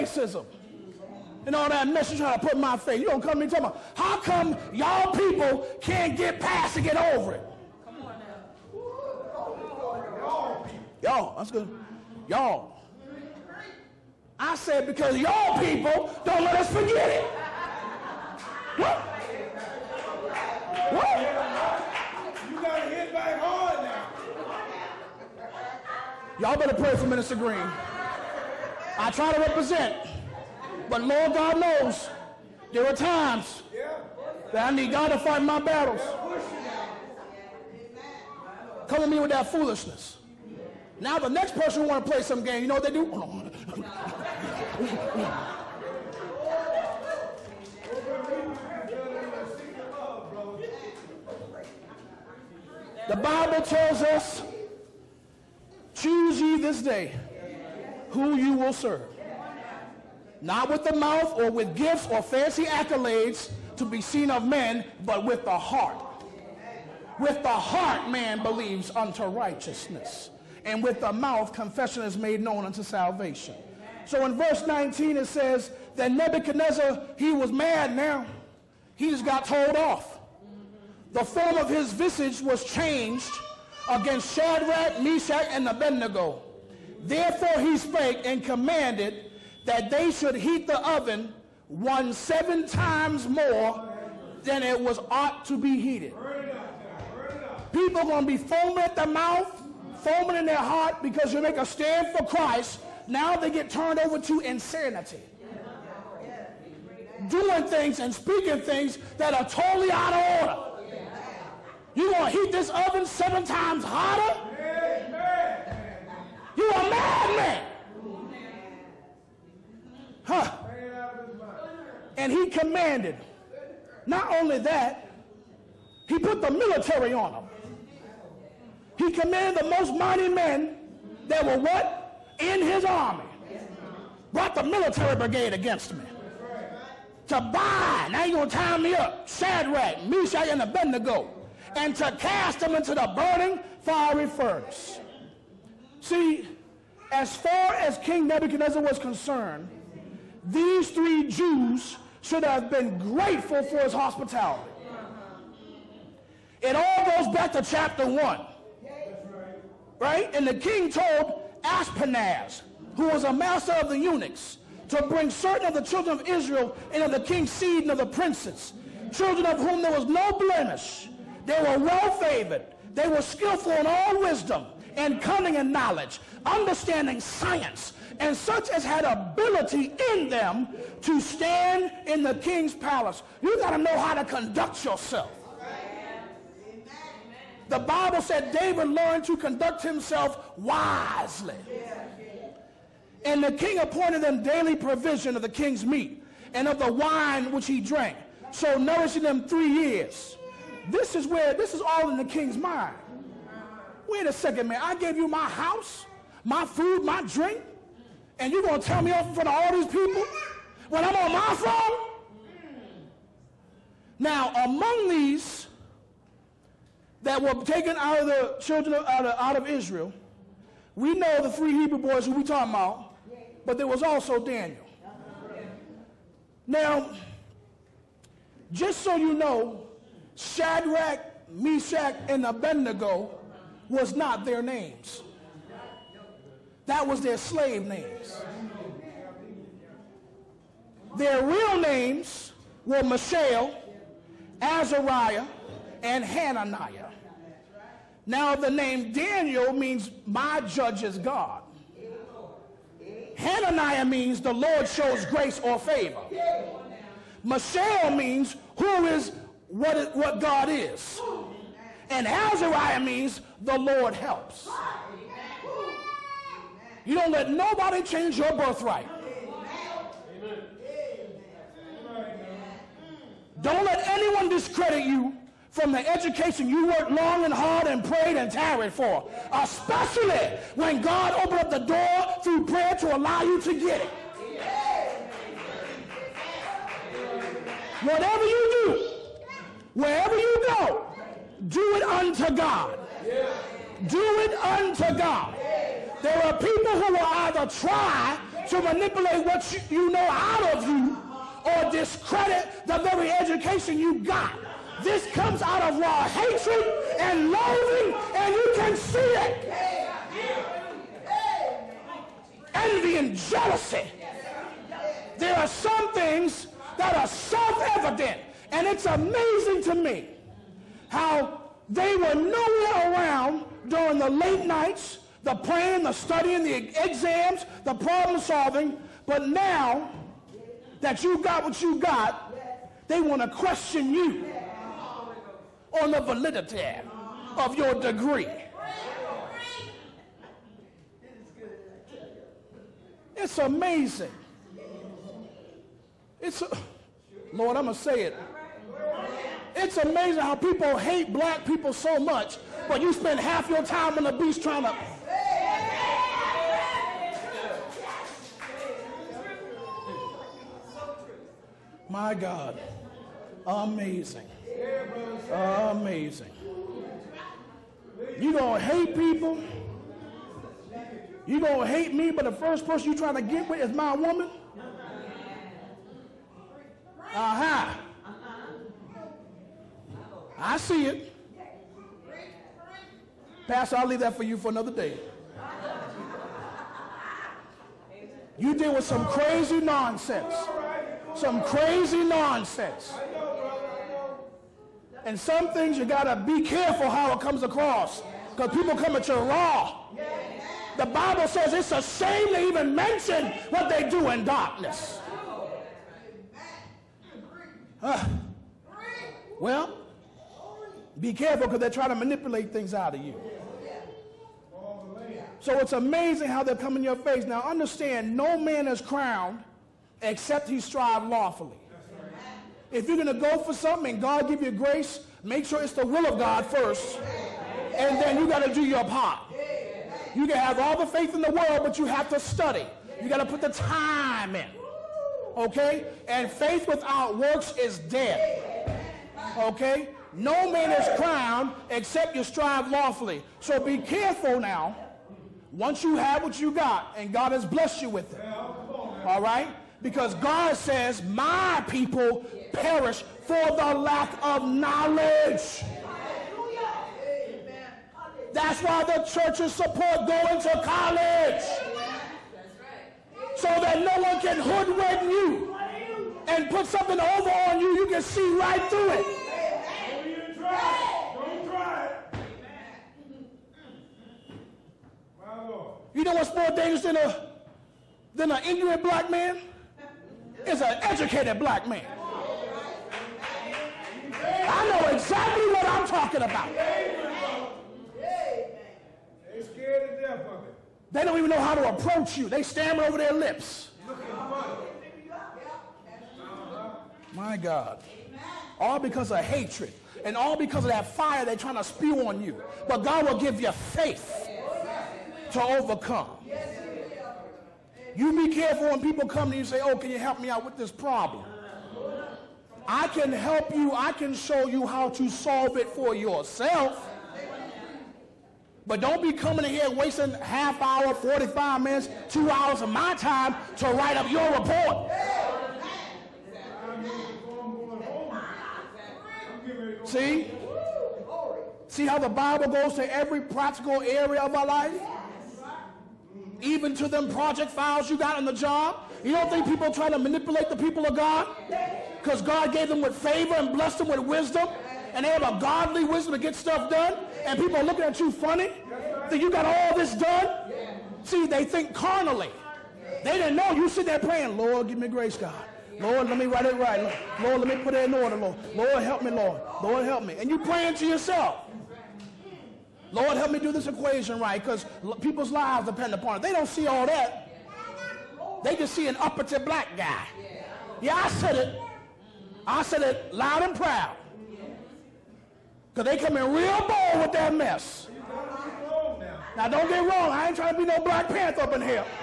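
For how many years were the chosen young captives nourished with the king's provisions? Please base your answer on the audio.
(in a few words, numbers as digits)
3.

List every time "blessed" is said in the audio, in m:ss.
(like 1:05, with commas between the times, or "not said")
7:27, 9:03.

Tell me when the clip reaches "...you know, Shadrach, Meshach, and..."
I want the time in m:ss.
3:49.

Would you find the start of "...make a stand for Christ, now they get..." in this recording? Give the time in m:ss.
1:41.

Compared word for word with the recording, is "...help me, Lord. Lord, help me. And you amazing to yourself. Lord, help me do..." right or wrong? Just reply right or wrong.
wrong.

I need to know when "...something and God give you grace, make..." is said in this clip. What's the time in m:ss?
7:03.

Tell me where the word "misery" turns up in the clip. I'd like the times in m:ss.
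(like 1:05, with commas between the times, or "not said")
not said.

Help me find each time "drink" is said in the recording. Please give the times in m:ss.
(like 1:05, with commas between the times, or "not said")
3:27.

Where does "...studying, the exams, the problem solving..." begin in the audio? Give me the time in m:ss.
5:26.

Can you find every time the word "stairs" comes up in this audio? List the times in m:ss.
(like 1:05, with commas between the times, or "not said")
not said.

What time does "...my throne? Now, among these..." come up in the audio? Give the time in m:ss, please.
3:31.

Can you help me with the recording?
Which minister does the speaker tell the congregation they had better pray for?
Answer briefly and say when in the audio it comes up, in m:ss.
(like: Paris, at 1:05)
Minister Green, at 0:27.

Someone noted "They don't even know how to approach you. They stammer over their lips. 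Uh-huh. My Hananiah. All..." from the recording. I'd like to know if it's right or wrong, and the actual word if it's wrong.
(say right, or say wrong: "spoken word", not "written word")
wrong: "God", not "Hananiah".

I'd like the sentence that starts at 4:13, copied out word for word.
Hananiah means the Lord shows grace or favor.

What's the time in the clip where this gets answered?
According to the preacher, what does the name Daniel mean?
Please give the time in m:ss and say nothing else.
4:10.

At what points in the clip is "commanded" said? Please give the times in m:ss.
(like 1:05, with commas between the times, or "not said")
1:28, 2:02, 2:09.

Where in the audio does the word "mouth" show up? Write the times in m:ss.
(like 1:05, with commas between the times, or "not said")
1:00, 1:11, 1:39.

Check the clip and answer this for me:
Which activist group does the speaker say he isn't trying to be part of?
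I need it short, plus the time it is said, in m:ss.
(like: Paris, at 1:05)
Black Panther, at 9:40.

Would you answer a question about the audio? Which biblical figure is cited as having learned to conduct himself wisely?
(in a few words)
David.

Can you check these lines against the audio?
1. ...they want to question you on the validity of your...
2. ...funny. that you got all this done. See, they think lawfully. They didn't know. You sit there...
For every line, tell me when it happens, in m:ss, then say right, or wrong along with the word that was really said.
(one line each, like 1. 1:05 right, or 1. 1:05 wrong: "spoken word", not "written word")
1. 5:33 right
2. 9:08 wrong: "carnally", not "lawfully".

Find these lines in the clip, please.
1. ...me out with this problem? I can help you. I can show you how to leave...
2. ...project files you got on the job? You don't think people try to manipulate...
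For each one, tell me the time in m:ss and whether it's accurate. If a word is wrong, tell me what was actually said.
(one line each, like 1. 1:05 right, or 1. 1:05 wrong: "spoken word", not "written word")
1. 8:30 wrong: "solve", not "leave"
2. 8:57 right.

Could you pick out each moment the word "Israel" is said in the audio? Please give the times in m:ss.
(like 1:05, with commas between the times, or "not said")
2:46, 3:39.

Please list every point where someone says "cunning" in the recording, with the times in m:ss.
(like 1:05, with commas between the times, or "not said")
2:55.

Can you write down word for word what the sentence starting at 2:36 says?
It all goes back to chapter 1 right?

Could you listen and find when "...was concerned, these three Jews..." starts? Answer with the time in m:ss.
2:28.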